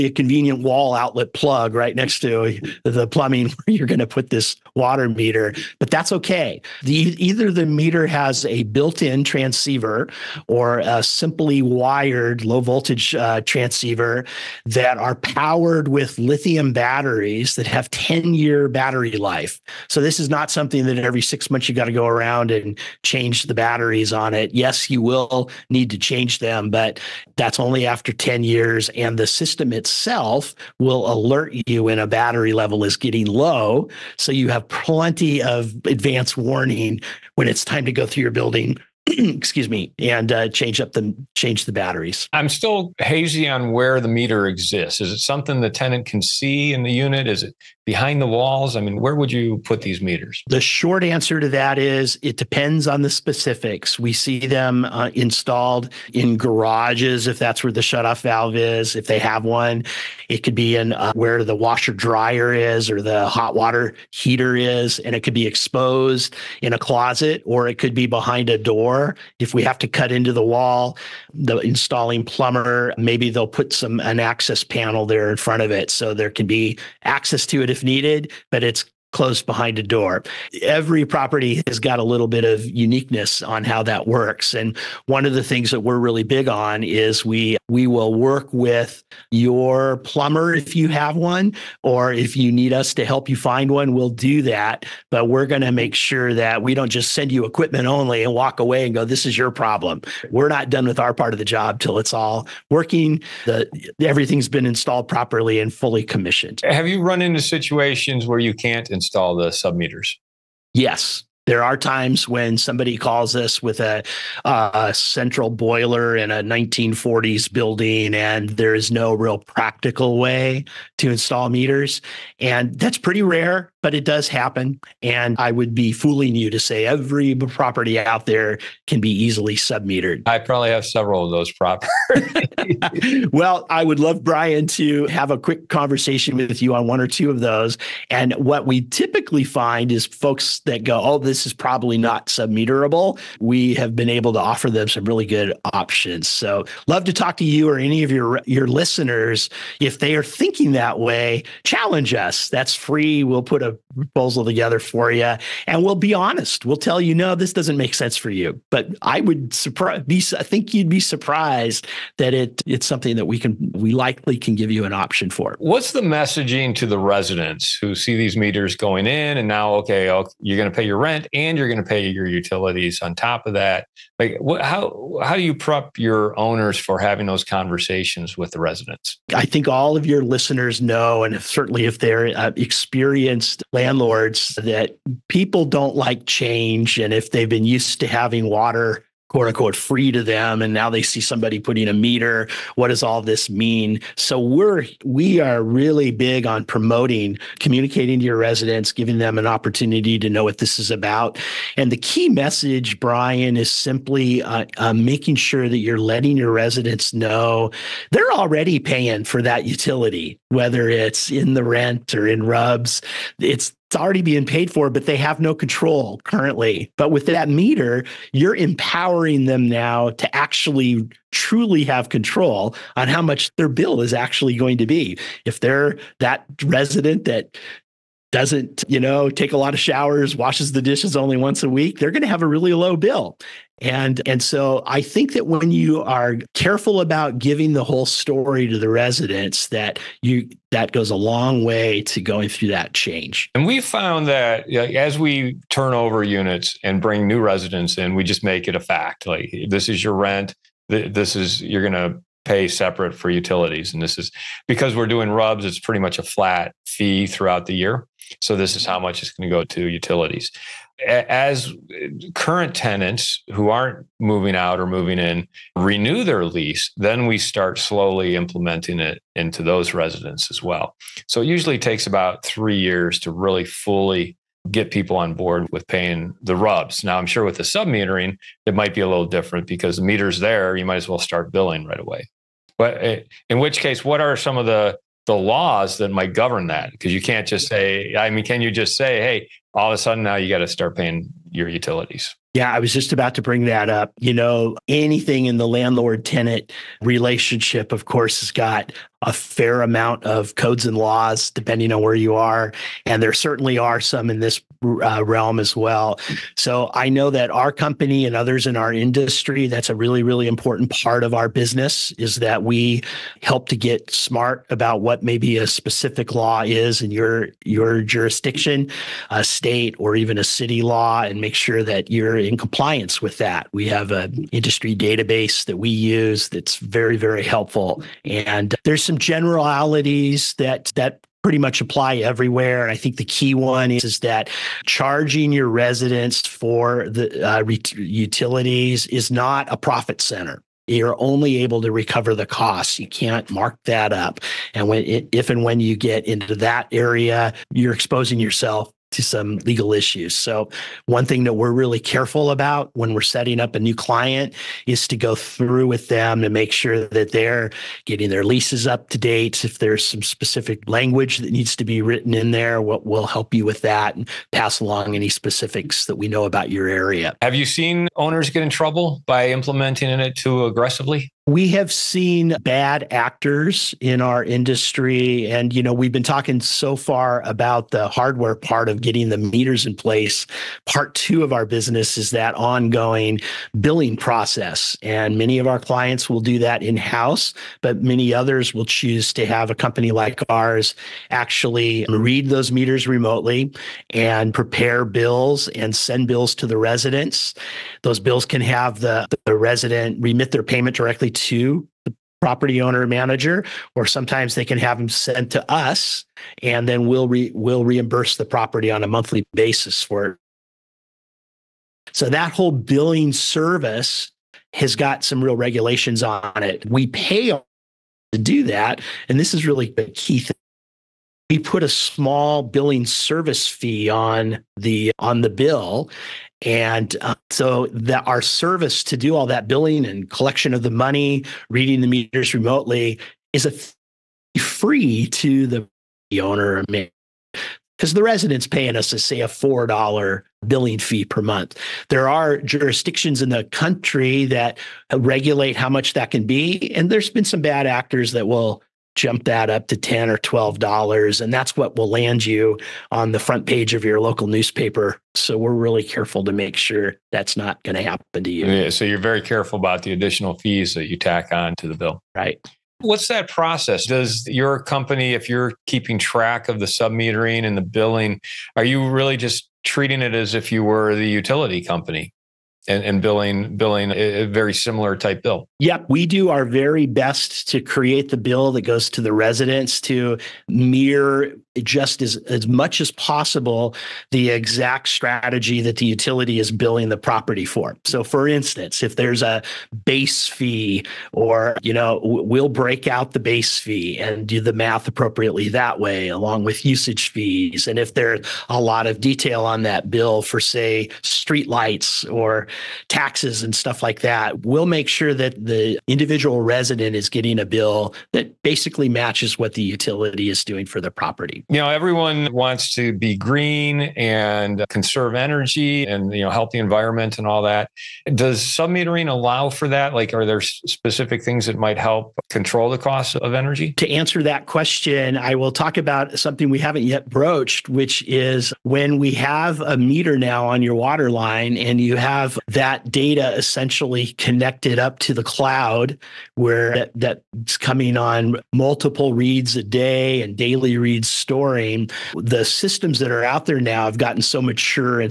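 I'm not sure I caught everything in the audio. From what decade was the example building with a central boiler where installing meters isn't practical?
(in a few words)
1940s.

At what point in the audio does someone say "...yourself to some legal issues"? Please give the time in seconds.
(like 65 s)
348 s.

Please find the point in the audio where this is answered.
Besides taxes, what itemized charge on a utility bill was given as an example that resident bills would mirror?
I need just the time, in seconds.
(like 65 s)
501 s.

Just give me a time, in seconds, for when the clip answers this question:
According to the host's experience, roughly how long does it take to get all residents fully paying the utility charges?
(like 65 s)
272 s.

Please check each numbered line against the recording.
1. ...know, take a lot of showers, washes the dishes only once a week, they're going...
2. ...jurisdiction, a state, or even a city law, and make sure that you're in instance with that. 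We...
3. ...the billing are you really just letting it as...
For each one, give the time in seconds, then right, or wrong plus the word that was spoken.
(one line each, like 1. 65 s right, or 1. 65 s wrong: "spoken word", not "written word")
1. 228 s right
2. 318 s wrong: "compliance", not "instance"
3. 467 s wrong: "treating", not "letting".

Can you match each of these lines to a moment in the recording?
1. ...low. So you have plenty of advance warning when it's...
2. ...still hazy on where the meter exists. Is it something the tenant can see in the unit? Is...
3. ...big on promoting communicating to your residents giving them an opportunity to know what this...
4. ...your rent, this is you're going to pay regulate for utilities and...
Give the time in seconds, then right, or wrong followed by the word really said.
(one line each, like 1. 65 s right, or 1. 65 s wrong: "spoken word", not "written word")
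1. 33 s right
2. 42 s right
3. 196 s right
4. 250 s wrong: "separate", not "regulate".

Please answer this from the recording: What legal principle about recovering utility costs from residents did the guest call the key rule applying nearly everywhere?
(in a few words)
not a profit center.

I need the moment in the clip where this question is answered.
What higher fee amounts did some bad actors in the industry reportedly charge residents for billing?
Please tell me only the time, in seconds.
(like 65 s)
449 s.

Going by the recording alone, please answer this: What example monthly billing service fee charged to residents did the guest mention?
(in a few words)
$4.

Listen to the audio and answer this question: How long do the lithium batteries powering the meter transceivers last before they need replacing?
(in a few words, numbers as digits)
10 years.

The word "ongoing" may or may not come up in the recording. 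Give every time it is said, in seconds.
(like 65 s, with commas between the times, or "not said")
382 s.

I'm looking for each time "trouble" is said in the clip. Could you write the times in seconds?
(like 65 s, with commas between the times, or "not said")
368 s.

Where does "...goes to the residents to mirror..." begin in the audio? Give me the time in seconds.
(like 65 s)
478 s.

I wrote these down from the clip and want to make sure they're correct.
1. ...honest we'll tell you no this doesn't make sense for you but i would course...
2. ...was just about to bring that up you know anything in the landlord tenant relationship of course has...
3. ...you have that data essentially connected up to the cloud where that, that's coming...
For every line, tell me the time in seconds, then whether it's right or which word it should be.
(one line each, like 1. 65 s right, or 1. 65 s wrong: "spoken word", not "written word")
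1. 156 s wrong: "surprise", not "course"
2. 292 s right
3. 532 s right.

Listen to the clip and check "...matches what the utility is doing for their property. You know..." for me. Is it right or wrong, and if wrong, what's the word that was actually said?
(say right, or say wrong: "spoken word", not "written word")
right.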